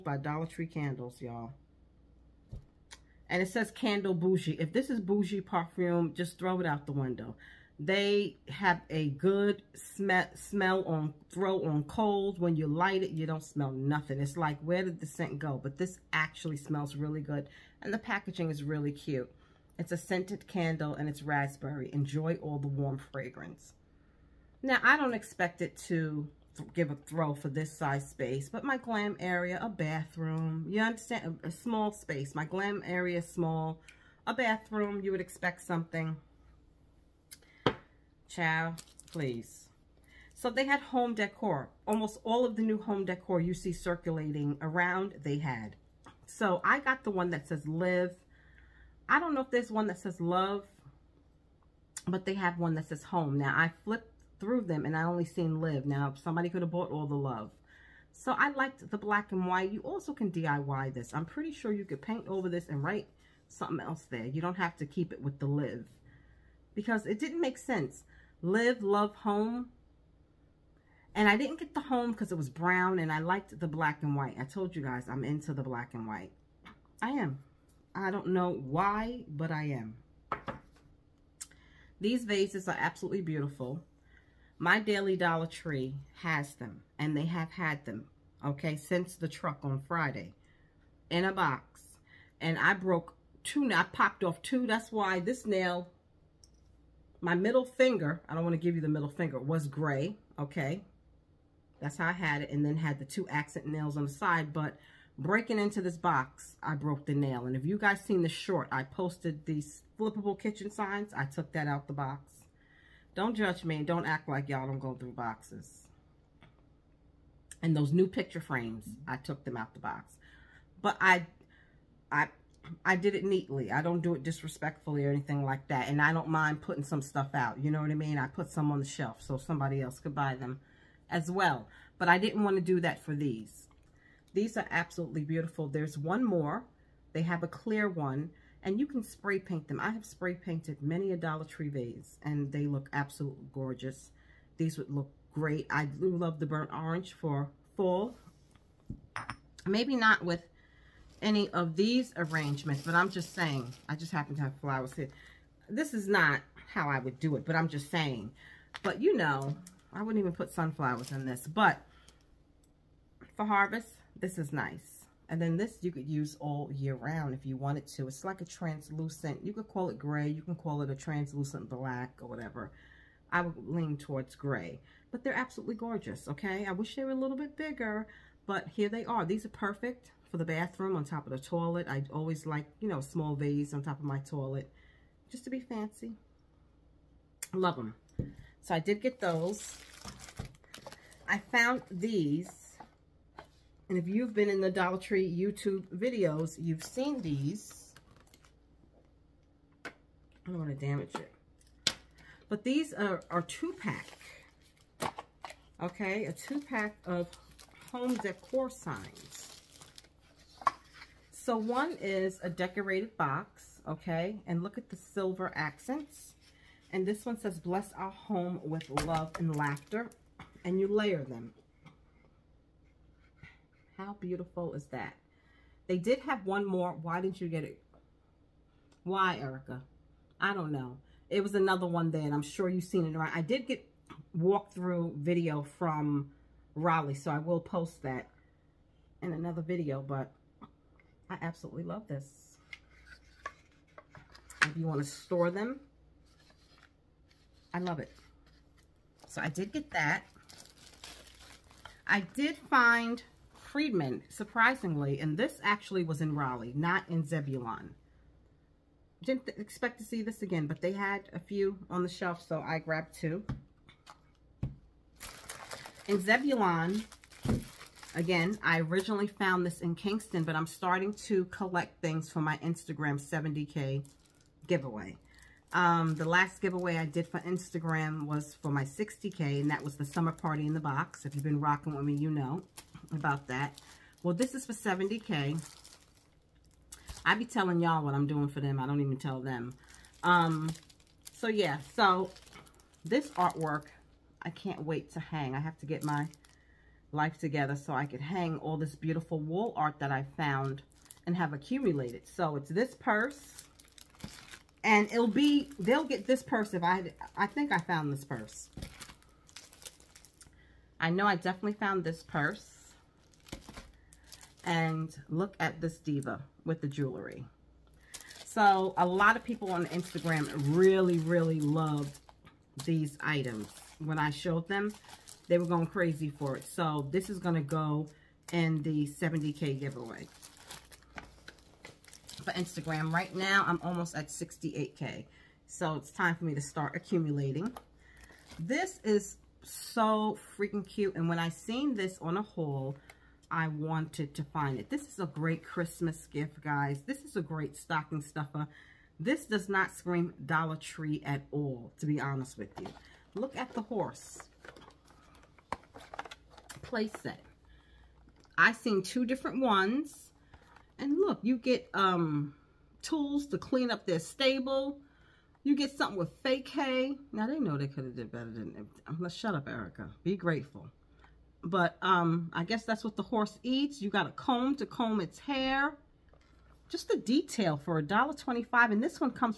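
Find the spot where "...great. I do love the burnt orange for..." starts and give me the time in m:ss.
2:25.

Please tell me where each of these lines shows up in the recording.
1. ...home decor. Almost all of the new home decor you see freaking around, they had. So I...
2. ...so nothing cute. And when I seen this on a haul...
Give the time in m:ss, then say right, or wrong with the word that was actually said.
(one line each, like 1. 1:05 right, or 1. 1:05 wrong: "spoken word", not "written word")
1. 0:40 wrong: "circulating", not "freaking"
2. 5:39 wrong: "freaking", not "nothing".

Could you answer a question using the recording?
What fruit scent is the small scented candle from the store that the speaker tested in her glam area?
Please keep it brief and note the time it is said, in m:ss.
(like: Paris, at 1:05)
Raspberry, at 0:21.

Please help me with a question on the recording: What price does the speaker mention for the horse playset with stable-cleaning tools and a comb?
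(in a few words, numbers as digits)
$1.25.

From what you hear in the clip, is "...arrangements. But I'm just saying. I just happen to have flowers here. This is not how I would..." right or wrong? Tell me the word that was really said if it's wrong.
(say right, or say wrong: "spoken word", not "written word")
right.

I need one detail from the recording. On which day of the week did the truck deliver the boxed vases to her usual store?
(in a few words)
Friday.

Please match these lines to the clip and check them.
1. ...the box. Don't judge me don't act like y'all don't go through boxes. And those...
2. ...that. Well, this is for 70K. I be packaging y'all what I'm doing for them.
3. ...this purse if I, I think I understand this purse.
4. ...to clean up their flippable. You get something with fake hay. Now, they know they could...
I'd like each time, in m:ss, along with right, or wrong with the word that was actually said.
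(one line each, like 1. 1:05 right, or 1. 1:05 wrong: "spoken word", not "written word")
1. 1:51 right
2. 4:43 wrong: "telling", not "packaging"
3. 5:06 wrong: "found", not "understand"
4. 6:03 wrong: "stable", not "flippable".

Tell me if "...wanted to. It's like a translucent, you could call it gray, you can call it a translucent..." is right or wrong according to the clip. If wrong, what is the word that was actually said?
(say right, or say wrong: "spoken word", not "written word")
right.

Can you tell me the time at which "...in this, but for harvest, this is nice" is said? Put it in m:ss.
2:41.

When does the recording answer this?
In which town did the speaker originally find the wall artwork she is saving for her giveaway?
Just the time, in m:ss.
4:29.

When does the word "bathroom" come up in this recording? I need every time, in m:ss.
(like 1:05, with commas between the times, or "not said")
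0:29, 0:34, 3:00.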